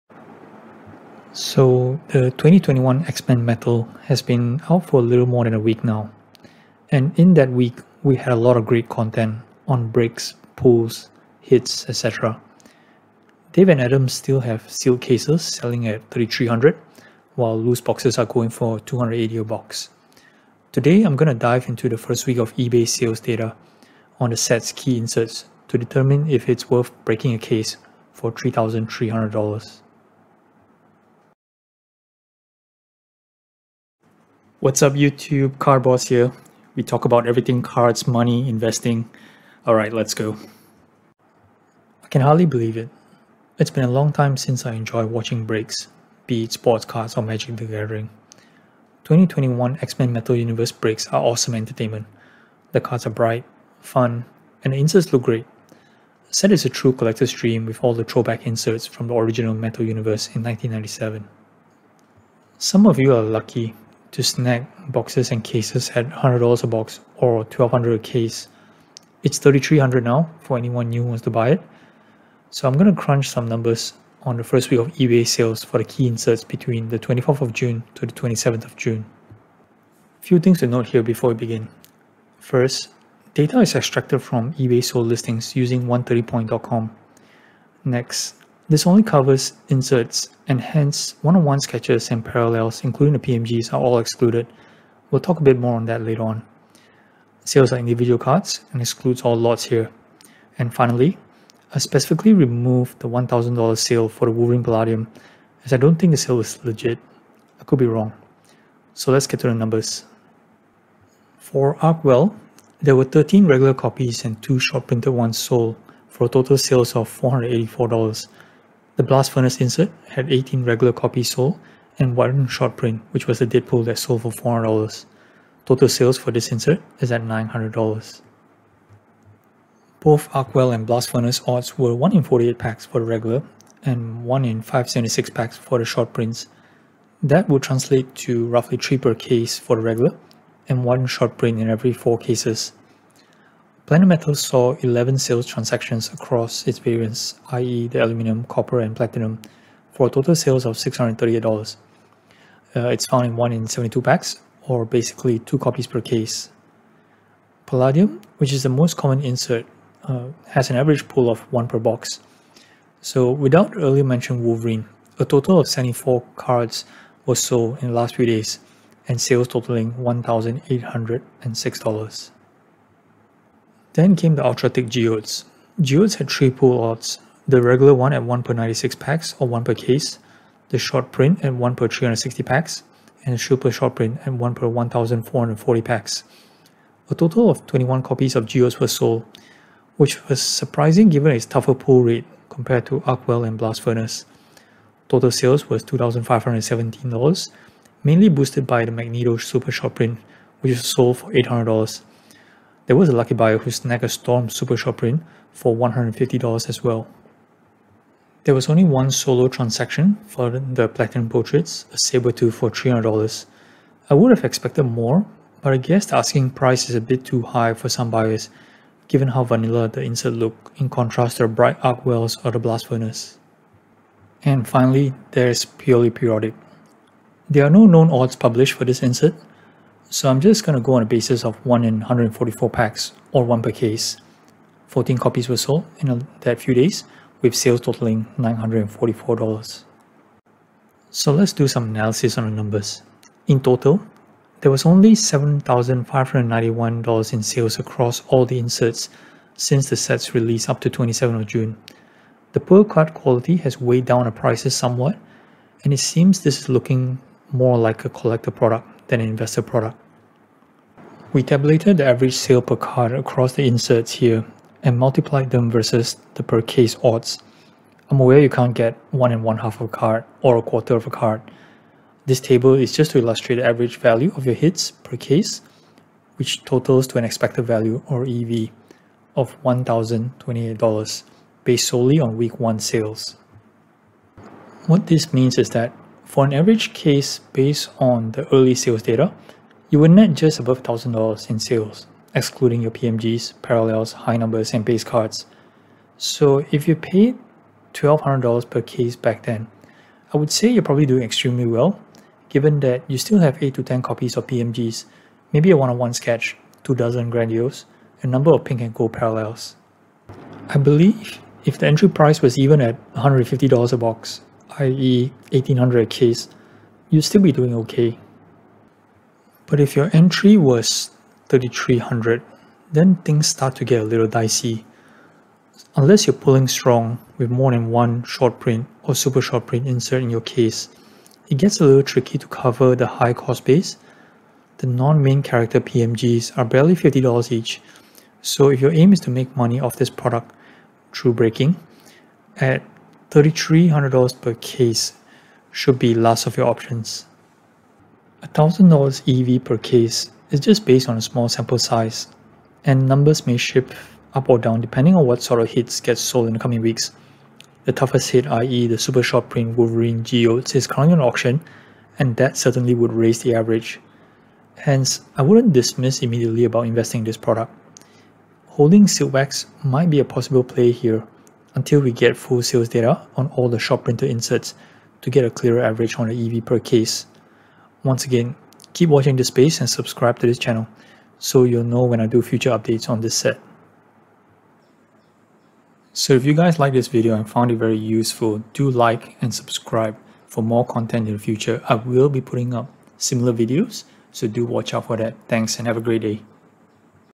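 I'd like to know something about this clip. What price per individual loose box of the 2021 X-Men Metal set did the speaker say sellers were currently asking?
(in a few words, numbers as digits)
$280.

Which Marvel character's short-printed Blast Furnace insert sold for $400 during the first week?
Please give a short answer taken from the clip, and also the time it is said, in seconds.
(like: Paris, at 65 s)
Deadpool, at 123 s.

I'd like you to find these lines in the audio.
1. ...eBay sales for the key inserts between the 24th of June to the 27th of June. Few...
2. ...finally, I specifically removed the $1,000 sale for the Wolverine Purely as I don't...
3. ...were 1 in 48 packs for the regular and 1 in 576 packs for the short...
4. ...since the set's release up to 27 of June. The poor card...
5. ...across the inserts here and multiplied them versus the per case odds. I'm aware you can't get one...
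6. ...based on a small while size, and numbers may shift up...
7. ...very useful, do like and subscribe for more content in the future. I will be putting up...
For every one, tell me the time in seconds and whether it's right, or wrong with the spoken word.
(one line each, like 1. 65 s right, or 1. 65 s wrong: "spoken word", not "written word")
1. 74 s right
2. 100 s wrong: "Palladium", not "Purely"
3. 131 s right
4. 249 s right
5. 263 s right
6. 350 s wrong: "sample", not "while"
7. 387 s right.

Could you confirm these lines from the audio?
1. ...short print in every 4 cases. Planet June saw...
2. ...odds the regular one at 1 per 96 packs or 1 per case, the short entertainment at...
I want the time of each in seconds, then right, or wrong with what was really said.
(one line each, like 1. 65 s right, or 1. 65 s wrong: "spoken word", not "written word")
1. 141 s wrong: "Metal", not "June"
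2. 176 s wrong: "print", not "entertainment".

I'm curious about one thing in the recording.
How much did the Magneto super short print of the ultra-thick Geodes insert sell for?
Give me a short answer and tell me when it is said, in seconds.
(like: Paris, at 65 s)
$800, at 201 s.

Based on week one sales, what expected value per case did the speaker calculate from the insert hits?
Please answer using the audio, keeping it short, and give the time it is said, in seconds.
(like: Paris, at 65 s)
$1,028, at 279 s.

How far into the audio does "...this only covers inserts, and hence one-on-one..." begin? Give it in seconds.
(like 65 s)
88 s.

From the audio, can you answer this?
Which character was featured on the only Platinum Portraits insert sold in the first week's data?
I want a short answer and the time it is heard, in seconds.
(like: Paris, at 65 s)
Sabretooth, at 211 s.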